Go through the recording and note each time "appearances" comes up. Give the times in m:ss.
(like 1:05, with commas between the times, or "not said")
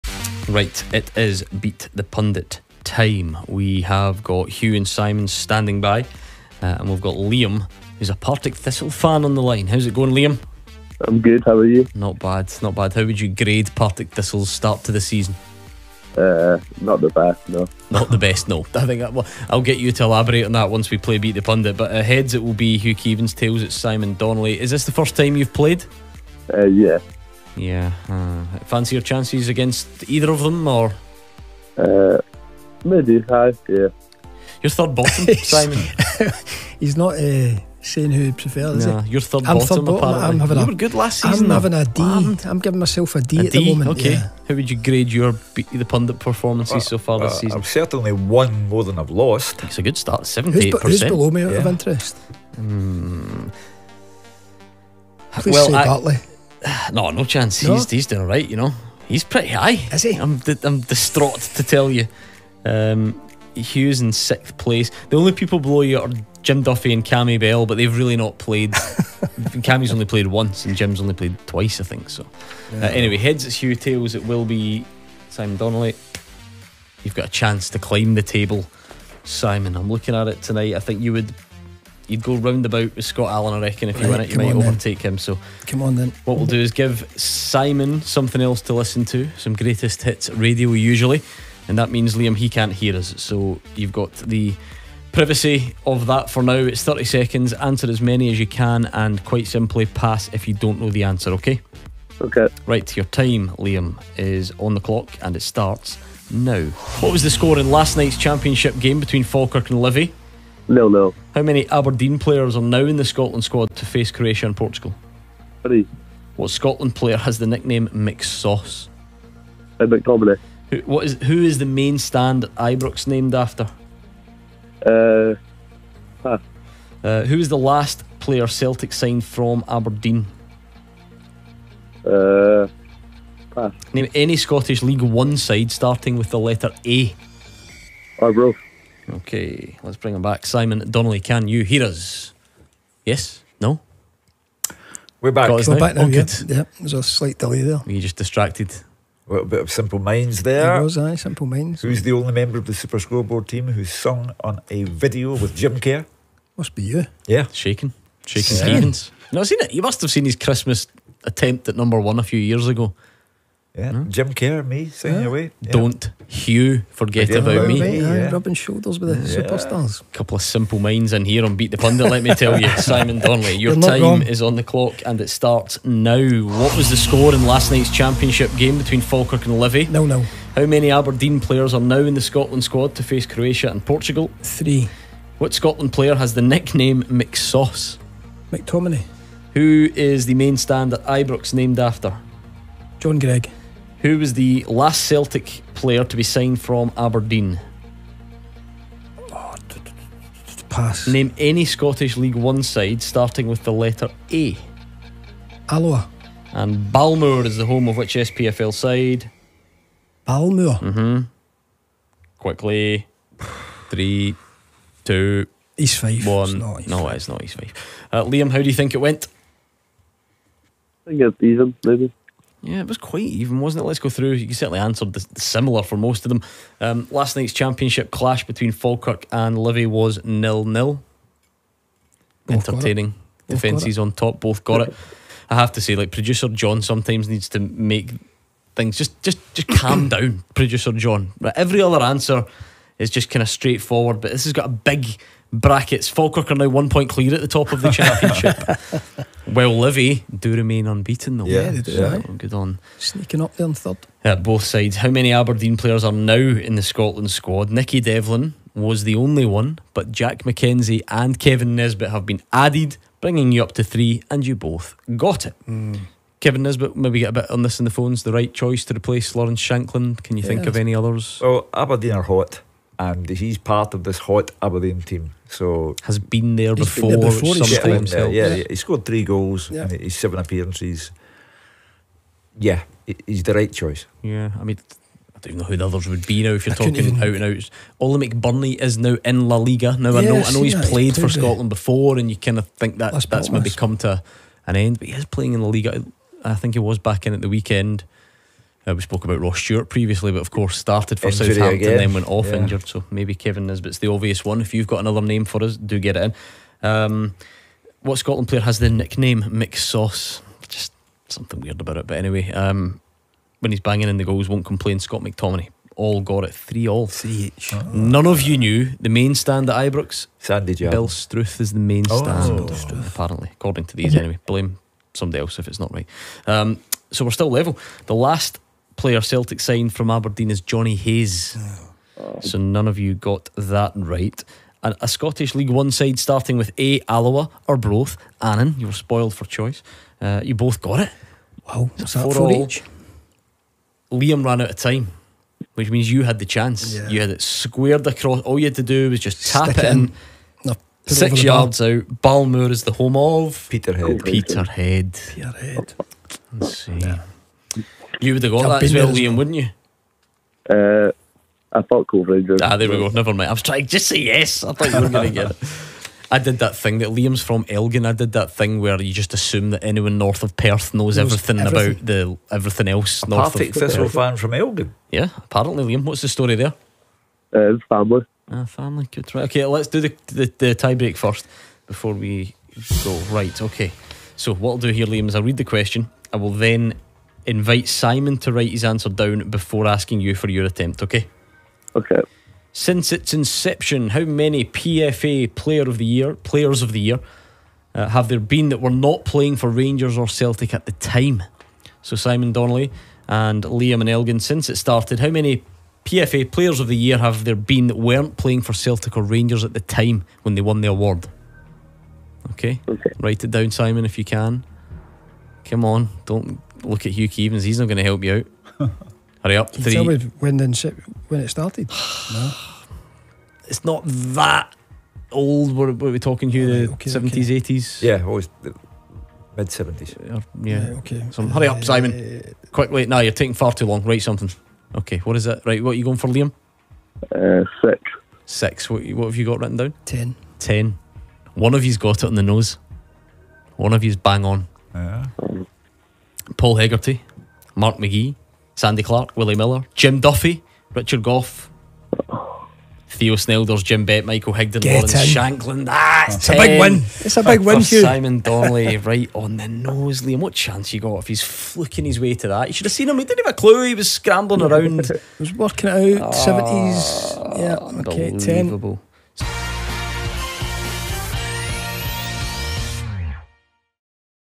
4:40.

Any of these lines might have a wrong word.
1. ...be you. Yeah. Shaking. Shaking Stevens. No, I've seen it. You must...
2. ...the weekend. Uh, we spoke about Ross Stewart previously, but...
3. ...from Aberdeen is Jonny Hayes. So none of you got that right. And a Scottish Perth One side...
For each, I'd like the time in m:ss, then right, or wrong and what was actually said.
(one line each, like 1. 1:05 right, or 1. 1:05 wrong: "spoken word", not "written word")
1. 2:36 right
2. 4:57 right
3. 5:29 wrong: "League", not "Perth".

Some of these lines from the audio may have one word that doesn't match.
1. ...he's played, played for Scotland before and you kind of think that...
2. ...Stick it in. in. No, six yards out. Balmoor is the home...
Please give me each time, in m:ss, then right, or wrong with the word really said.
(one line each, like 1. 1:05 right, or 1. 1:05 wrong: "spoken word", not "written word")
1. 4:50 right
2. 5:49 right.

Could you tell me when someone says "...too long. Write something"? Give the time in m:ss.
7:13.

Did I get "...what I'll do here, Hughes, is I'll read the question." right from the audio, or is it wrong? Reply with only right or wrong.
wrong.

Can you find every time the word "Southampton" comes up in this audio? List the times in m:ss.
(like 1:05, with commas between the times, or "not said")
5:01.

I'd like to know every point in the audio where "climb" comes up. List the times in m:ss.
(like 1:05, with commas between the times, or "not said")
1:17.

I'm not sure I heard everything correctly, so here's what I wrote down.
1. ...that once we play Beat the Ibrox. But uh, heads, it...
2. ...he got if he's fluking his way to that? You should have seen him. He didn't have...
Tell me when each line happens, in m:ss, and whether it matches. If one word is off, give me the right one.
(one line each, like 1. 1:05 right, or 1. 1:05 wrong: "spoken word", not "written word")
1. 0:20 wrong: "Pundit", not "Ibrox"
2. 7:40 right.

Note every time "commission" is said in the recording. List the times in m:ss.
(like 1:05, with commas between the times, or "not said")
not said.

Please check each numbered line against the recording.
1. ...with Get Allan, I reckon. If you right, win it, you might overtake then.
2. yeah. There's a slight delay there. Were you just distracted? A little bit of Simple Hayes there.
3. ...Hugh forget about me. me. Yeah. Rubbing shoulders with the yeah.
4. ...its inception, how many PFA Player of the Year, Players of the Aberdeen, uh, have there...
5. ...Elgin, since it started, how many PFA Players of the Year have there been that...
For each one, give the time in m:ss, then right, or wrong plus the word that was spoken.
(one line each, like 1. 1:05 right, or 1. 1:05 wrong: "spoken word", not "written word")
1. 1:22 wrong: "Scott", not "Get"
2. 2:26 wrong: "Minds", not "Hayes"
3. 2:46 right
4. 6:33 wrong: "Year", not "Aberdeen"
5. 6:44 right.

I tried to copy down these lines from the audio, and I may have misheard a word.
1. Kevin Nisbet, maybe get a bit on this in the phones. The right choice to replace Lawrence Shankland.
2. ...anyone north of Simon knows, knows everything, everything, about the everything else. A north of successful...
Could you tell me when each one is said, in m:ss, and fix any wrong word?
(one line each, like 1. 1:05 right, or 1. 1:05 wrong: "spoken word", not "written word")
1. 4:26 right
2. 6:09 wrong: "Perth", not "Simon".